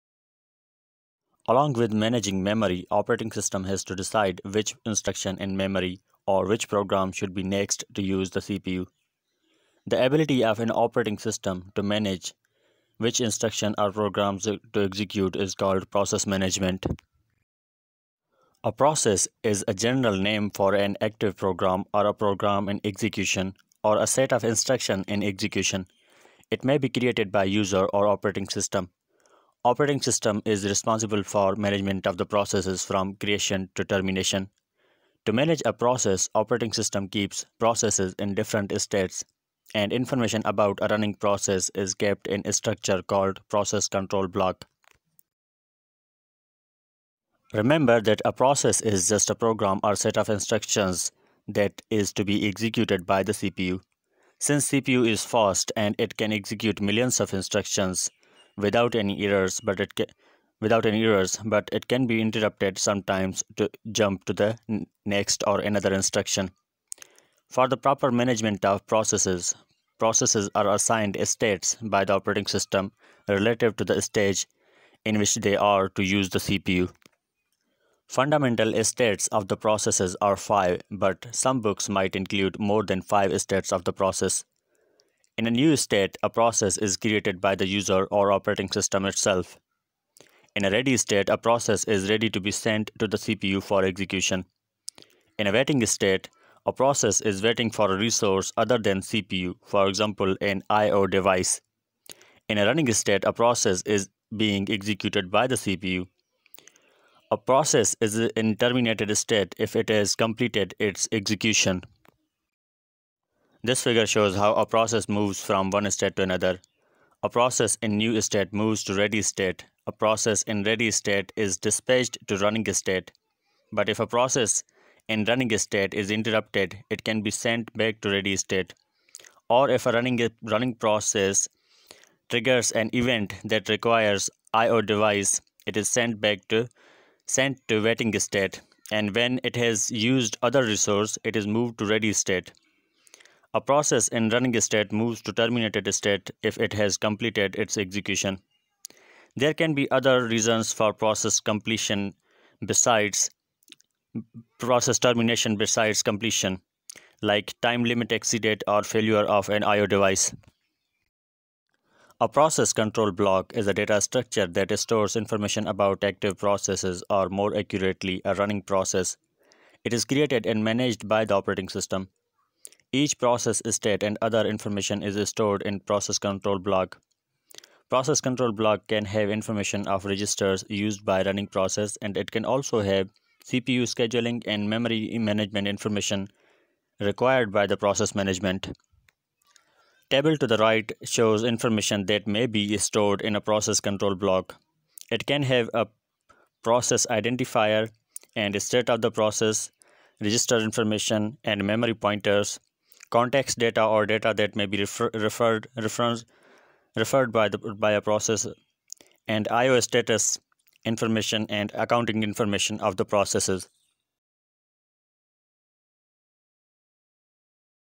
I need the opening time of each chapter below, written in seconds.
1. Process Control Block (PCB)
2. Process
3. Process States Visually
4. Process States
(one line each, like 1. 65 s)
1. 161 s
2. 17 s
3. 113 s
4. 45 s.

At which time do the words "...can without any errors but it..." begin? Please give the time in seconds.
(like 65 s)
59 s.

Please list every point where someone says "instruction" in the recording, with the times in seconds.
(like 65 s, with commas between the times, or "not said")
4 s, 13 s, 24 s, 50 s, 57 s, 65 s.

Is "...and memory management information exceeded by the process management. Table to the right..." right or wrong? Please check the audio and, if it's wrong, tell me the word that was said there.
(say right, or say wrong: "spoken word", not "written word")
wrong: "required", not "exceeded".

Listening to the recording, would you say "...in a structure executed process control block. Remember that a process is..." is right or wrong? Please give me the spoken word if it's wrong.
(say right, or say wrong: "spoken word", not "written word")
wrong: "called", not "executed".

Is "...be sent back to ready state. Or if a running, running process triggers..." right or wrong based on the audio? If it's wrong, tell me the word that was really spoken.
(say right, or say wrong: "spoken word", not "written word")
right.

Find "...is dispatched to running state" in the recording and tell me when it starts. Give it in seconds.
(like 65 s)
121 s.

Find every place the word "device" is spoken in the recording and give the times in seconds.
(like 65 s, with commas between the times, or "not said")
101 s, 134 s, 159 s.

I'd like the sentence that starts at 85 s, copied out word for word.
In a new state, a process is created by the user or operating system itself.